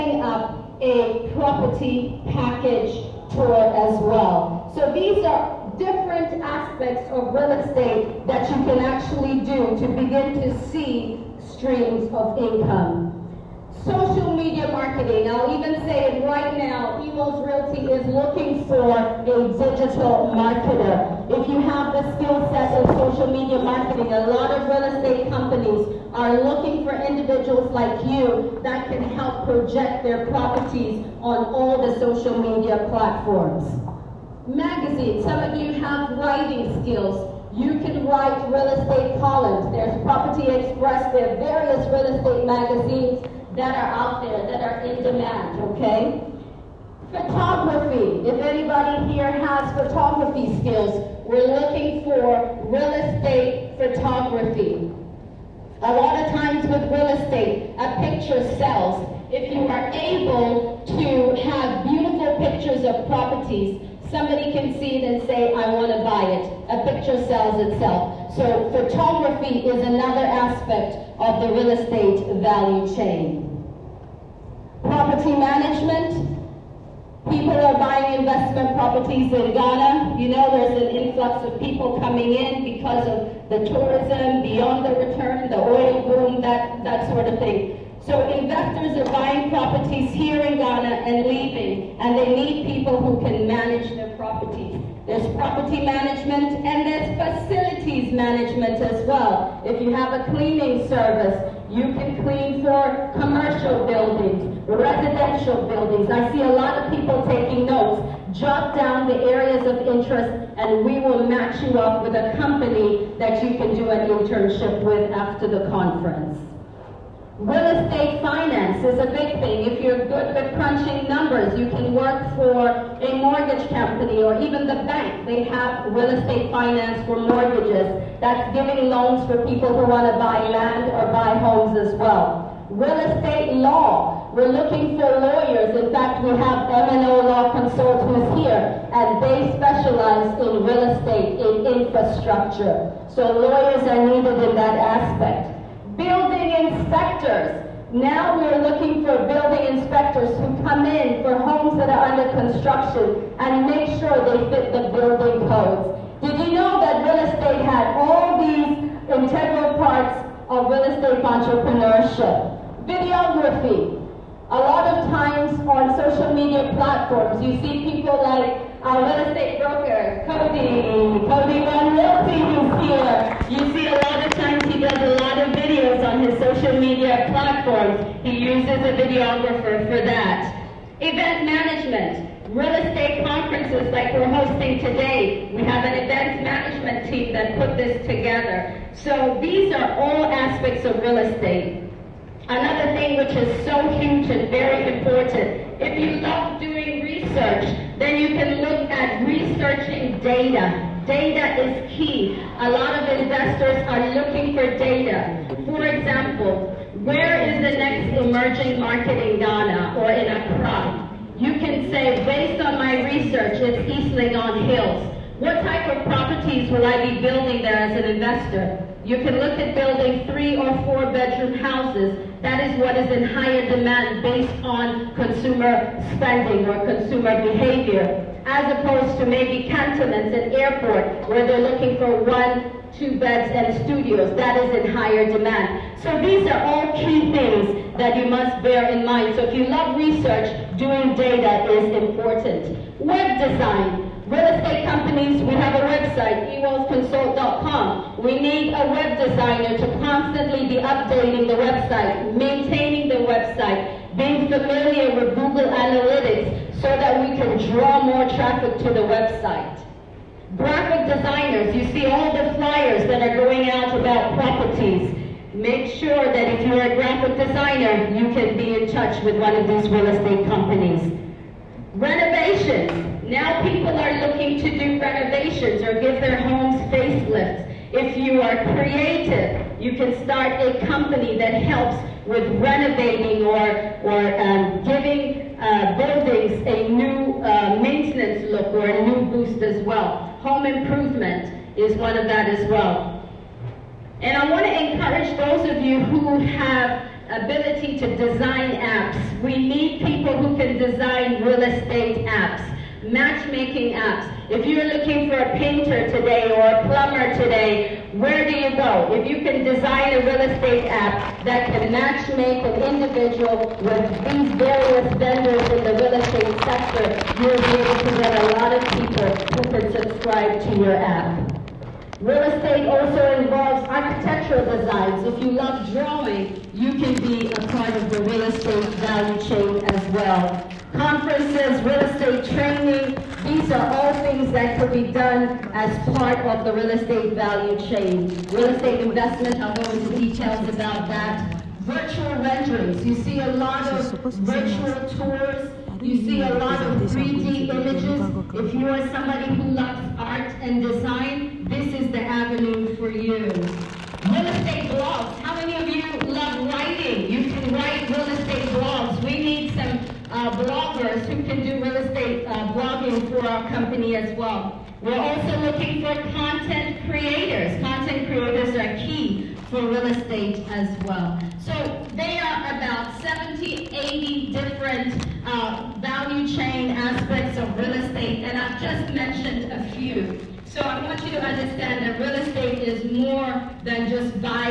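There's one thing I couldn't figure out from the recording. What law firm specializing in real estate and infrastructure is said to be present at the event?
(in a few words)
M&O Law Consult.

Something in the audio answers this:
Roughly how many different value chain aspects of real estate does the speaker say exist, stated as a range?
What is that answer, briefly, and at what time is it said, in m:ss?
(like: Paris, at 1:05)
70 to 80, at 6:13.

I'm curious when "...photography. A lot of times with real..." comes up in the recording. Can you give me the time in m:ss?
0:53.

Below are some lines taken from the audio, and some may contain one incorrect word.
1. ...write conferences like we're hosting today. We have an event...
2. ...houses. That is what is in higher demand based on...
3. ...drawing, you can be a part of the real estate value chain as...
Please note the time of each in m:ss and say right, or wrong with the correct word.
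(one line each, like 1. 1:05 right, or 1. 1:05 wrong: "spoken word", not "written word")
1. 3:02 wrong: "estate", not "write"
2. 3:41 right
3. 5:25 right.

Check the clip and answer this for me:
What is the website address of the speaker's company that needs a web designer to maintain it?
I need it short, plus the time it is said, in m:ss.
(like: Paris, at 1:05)
ewellsconsult.com, at 4:06.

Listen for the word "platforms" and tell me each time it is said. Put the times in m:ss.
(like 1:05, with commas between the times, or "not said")
0:32, 2:46, 2:57.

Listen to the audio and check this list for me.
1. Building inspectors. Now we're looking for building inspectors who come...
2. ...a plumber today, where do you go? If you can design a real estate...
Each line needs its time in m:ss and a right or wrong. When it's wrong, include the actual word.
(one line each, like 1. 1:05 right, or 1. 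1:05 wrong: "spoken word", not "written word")
1. 2:25 right
2. 5:06 right.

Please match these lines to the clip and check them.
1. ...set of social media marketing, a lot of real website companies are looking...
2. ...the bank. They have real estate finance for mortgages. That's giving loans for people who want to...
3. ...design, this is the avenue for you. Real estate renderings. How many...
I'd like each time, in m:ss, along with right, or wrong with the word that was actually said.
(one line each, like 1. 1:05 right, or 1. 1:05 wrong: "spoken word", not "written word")
1. 0:22 wrong: "estate", not "website"
2. 2:04 right
3. 5:50 wrong: "blogs", not "renderings".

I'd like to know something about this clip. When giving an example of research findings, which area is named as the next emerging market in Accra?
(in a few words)
East Legon Hills.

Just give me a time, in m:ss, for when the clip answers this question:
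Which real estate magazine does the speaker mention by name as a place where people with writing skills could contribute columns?
0:40.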